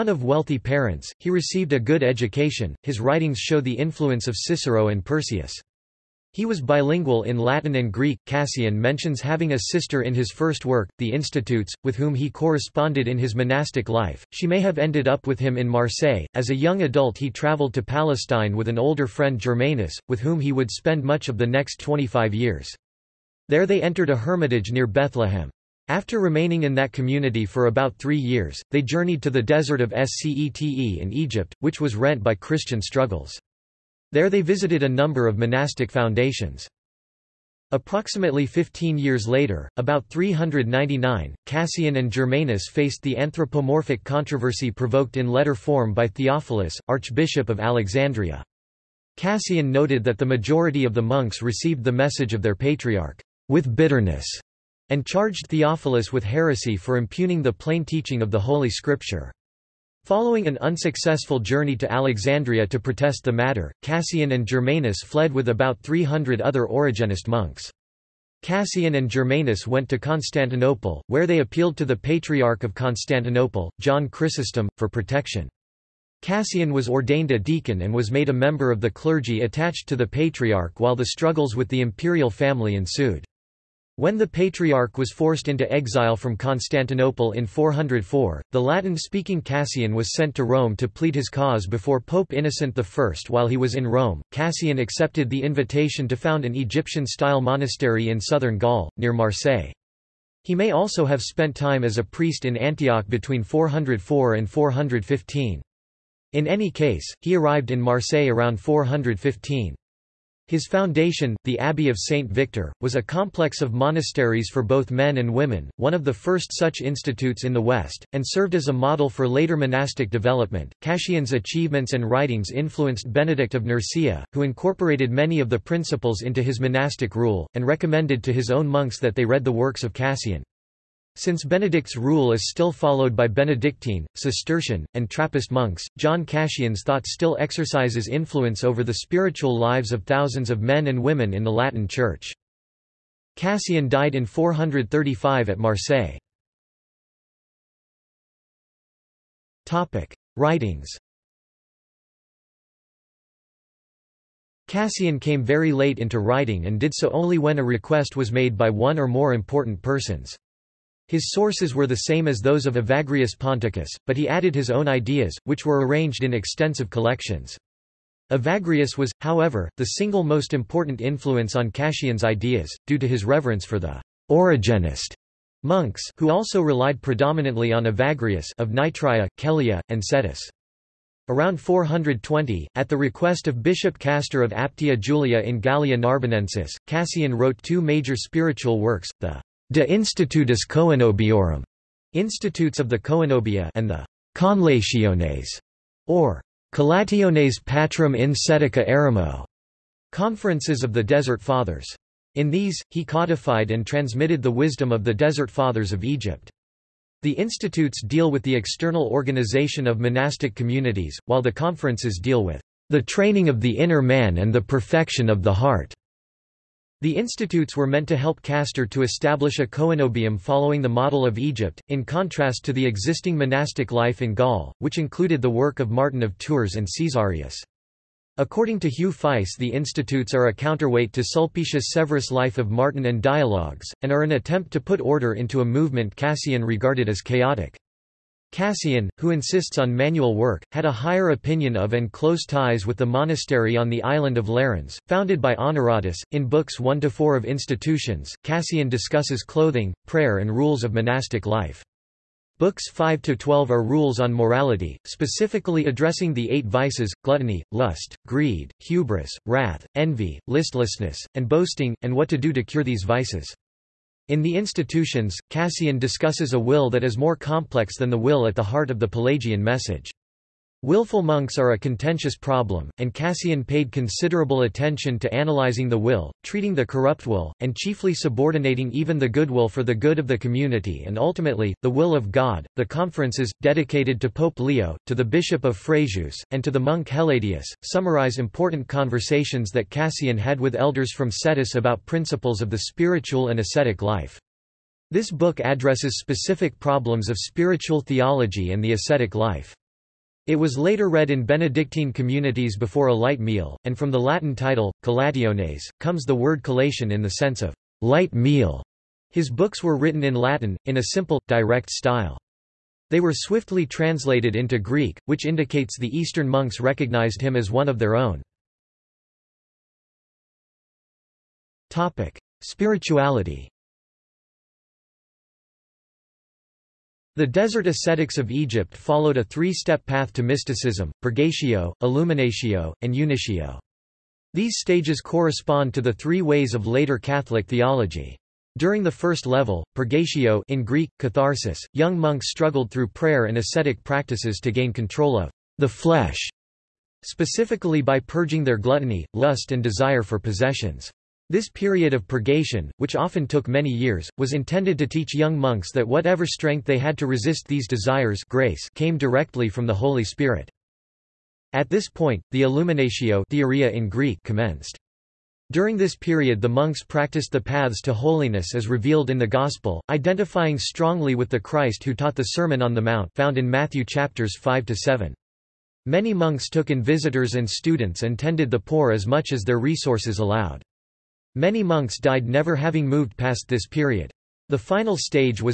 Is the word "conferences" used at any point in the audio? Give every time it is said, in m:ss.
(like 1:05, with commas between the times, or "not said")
3:20, 3:31, 4:42.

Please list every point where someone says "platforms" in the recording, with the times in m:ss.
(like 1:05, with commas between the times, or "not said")
not said.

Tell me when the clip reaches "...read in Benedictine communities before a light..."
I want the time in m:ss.
5:01.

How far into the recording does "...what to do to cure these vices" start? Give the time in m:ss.
4:22.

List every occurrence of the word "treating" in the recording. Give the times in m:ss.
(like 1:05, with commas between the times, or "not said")
4:36.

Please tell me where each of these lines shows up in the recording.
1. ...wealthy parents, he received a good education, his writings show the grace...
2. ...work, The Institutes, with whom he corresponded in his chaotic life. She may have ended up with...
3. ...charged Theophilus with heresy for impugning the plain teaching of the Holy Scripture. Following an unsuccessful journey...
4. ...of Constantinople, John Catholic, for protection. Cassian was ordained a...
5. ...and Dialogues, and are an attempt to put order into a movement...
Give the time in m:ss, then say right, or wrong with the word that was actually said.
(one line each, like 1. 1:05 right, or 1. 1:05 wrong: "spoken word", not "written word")
1. 0:00 wrong: "influence", not "grace"
2. 0:10 wrong: "monastic", not "chaotic"
3. 0:55 right
4. 1:12 wrong: "Chrysostom", not "Catholic"
5. 3:53 right.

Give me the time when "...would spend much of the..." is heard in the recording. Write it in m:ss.
0:20.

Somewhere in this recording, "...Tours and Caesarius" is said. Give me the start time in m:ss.
3:46.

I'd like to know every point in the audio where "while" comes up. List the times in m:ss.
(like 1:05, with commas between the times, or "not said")
1:20, 1:33, 3:31.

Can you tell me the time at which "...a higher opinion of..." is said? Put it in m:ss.
4:00.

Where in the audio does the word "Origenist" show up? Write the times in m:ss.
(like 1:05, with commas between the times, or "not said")
1:06, 2:54.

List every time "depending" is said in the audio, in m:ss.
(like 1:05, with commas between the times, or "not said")
not said.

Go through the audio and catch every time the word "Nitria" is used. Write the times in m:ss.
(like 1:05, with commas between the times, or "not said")
2:58.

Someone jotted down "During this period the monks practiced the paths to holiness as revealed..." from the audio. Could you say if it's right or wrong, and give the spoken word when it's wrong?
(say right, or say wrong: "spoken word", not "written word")
right.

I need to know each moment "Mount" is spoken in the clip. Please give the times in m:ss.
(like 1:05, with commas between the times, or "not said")
6:13.